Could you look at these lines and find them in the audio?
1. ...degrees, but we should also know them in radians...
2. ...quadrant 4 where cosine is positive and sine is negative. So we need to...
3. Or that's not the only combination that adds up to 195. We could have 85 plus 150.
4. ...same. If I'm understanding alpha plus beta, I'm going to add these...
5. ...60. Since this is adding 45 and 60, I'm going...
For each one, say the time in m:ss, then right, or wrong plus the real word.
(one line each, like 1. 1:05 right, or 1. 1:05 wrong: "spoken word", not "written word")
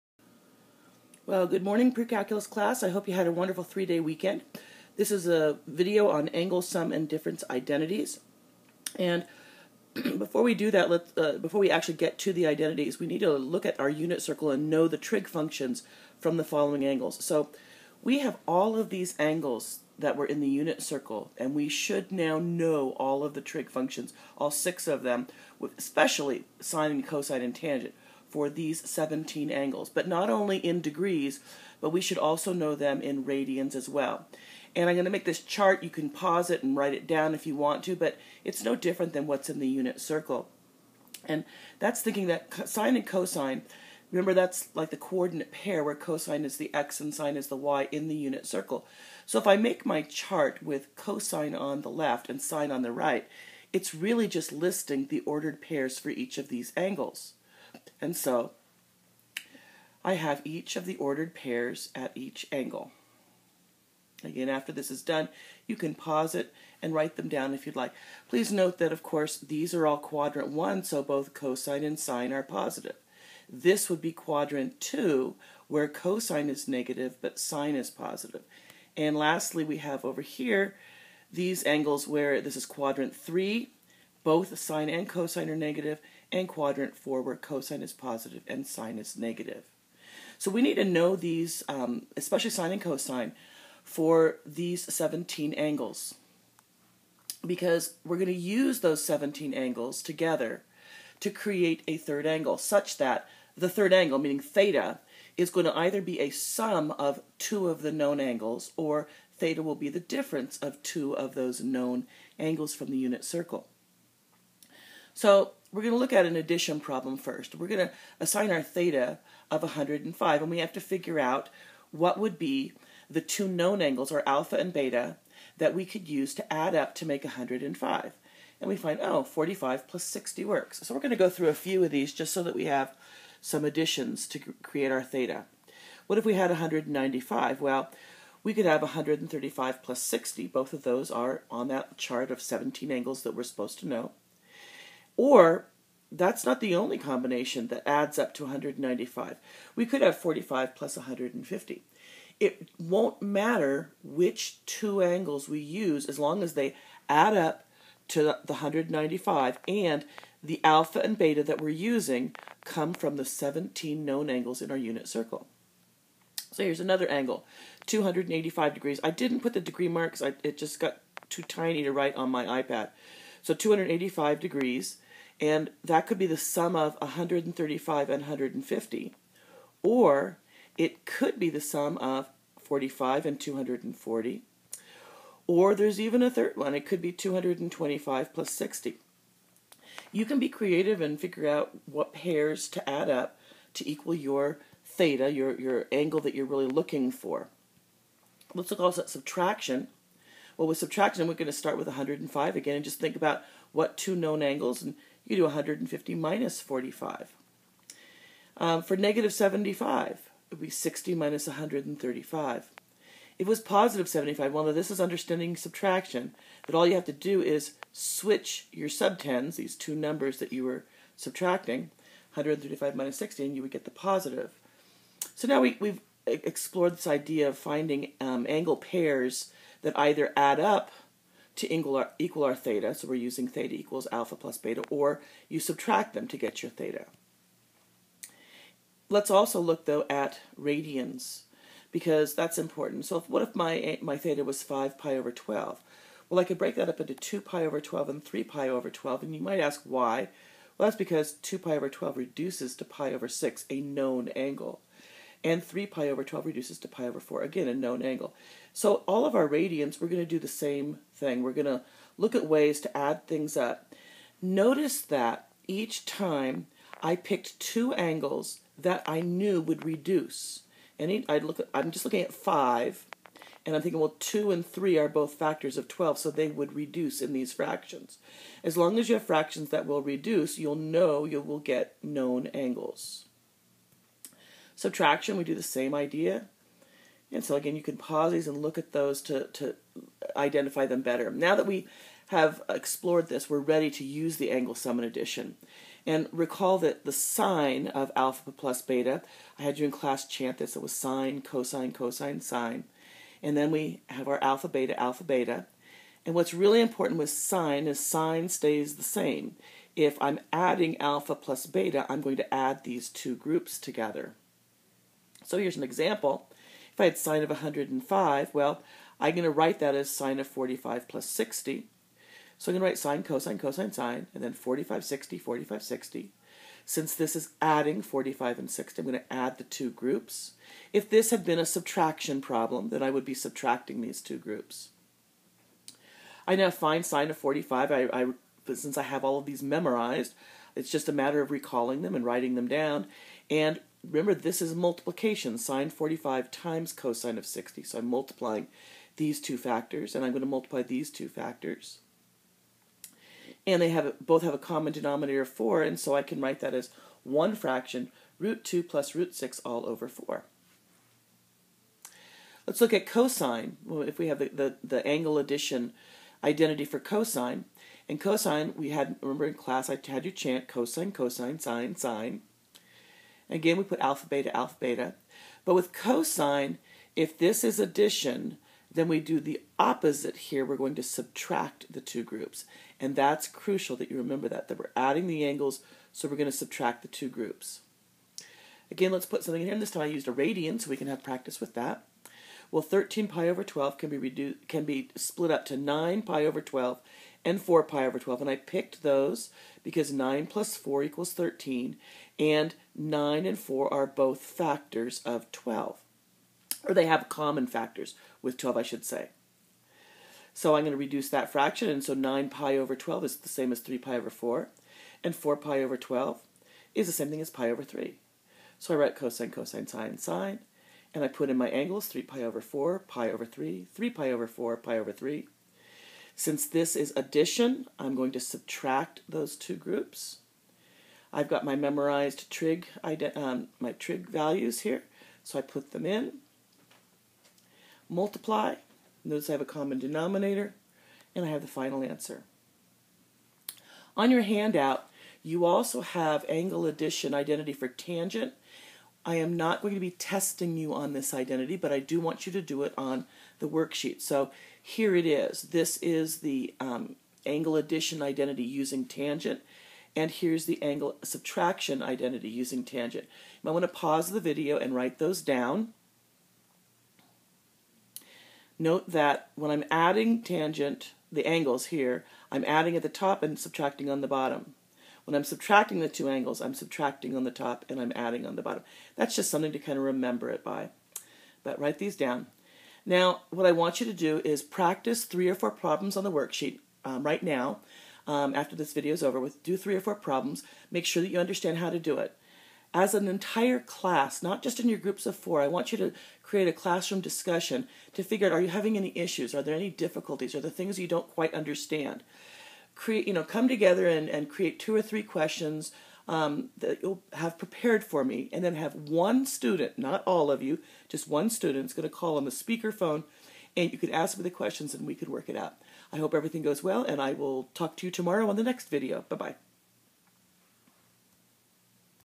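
1. 0:30 right
2. 1:26 right
3. 2:25 wrong: "45", not "85"
4. 5:09 wrong: "adding", not "understanding"
5. 5:25 right.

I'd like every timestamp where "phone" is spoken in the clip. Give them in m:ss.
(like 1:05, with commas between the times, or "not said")
8:32.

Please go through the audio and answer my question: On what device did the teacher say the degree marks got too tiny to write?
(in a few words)
iPad.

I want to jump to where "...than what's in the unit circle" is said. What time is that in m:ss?
0:39.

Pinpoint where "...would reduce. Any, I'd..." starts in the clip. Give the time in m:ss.
4:29.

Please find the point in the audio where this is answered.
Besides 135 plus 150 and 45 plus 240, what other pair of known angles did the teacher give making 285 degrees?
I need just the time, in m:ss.
3:07.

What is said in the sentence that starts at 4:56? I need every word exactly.
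And recall that the sine of alpha plus beta, I had you in class chant this, it was sine, cosine, cosine, sine.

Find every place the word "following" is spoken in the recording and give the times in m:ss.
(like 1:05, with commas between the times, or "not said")
0:16.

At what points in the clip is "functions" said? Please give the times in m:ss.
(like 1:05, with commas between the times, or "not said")
0:15, 0:23.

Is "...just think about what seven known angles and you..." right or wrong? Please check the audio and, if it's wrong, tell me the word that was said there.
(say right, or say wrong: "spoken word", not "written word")
wrong: "two", not "seven".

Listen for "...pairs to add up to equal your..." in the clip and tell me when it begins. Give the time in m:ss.
3:12.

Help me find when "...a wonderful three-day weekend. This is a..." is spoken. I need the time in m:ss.
0:03.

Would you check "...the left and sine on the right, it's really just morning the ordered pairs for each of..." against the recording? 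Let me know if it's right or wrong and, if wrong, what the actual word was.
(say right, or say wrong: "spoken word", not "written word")
wrong: "listing", not "morning".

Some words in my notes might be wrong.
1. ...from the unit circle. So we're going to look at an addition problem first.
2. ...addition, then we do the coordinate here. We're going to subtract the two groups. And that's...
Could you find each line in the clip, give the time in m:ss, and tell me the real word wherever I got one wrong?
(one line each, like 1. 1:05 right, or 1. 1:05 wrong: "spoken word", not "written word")
1. 1:52 right
2. 6:17 wrong: "opposite", not "coordinate".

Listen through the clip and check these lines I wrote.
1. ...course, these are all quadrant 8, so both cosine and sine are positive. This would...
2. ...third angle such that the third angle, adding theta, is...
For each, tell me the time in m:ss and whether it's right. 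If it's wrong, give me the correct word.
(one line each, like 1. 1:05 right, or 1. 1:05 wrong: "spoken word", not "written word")
1. 1:09 wrong: "1", not "8"
2. 1:41 wrong: "meaning", not "adding".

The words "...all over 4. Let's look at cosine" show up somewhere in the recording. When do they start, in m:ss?
5:59.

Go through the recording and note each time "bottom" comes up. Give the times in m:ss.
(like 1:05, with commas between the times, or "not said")
7:54, 7:58.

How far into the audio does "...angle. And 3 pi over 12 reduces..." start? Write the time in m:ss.
4:14.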